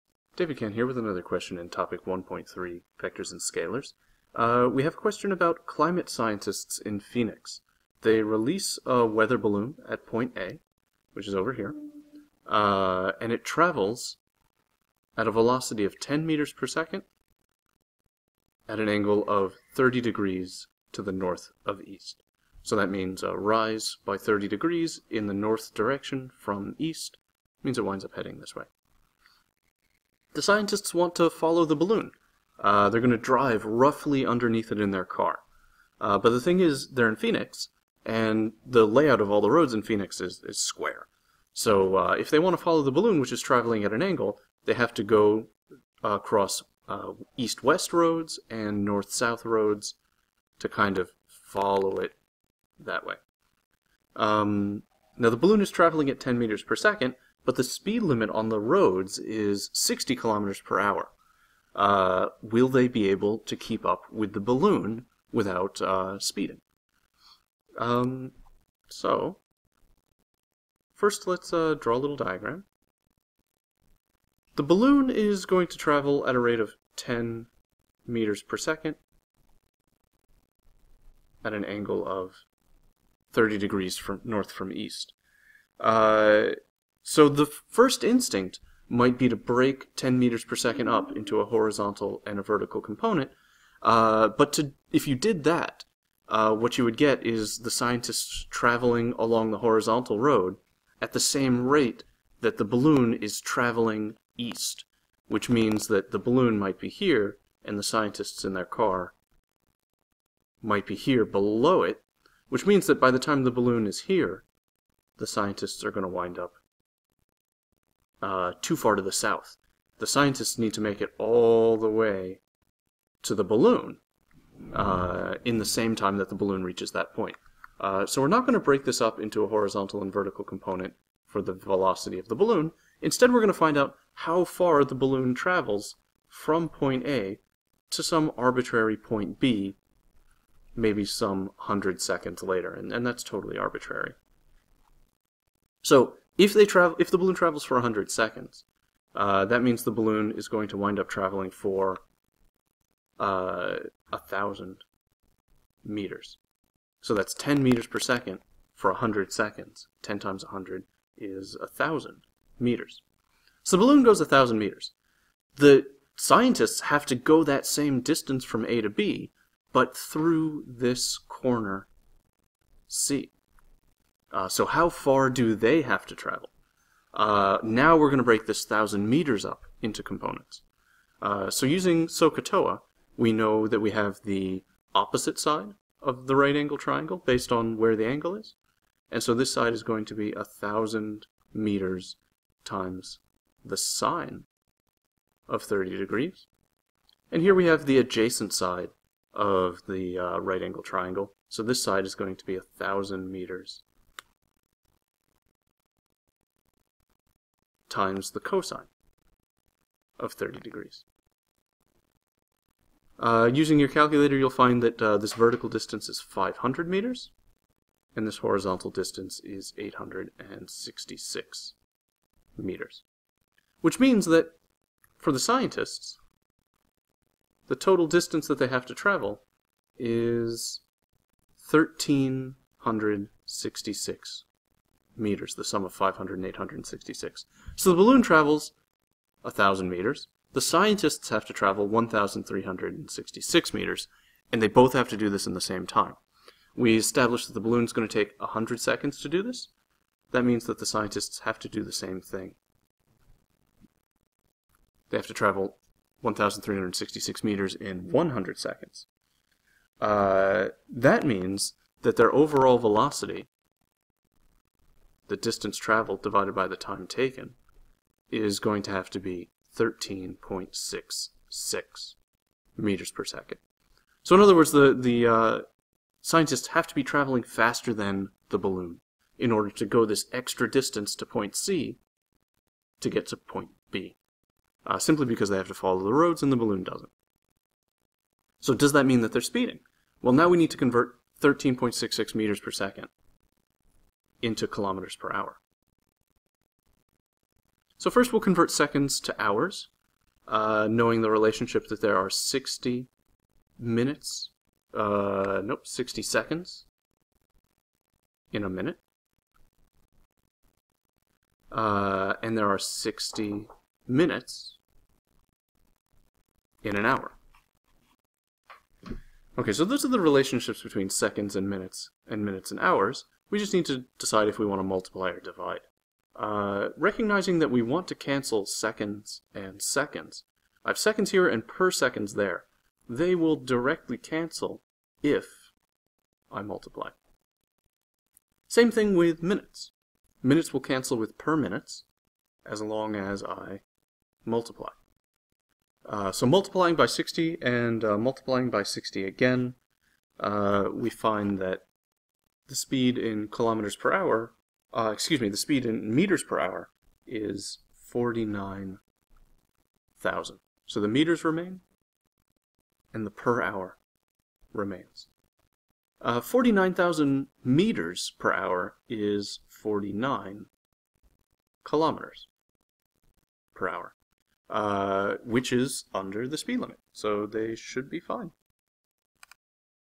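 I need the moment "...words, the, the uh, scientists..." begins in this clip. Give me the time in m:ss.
4:34.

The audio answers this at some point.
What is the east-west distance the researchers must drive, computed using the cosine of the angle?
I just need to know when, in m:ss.
3:39.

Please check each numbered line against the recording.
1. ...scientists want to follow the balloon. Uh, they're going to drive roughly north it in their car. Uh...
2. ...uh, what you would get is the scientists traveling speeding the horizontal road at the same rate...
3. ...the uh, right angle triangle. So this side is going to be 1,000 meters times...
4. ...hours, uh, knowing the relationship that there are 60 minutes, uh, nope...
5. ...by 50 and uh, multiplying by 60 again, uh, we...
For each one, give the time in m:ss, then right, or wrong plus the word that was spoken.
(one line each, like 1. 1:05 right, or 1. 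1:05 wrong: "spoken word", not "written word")
1. 0:30 wrong: "underneath", not "north"
2. 1:36 wrong: "along", not "speeding"
3. 3:19 right
4. 4:59 right
5. 5:46 wrong: "60", not "50".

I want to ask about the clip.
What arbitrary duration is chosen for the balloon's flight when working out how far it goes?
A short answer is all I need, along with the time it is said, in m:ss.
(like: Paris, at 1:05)
100 seconds, at 2:21.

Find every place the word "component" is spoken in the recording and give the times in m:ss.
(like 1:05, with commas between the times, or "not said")
1:32, 2:10, 3:00.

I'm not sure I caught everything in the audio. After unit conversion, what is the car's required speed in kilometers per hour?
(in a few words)
49 kilometers per hour.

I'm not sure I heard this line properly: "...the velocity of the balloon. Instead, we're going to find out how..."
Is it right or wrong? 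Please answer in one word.
right.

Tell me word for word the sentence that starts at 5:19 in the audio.
Okay, so those are the relationships between seconds and minutes, and minutes and hours.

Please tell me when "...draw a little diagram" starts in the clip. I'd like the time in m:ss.
1:11.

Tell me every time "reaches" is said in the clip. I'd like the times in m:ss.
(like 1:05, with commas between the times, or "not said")
2:06.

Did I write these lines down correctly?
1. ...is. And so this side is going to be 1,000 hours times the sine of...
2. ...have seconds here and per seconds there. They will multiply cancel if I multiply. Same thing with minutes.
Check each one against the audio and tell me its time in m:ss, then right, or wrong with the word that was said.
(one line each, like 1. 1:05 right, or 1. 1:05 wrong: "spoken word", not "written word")
1. 3:08 wrong: "meters", not "hours"
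2. 5:30 wrong: "directly", not "multiply".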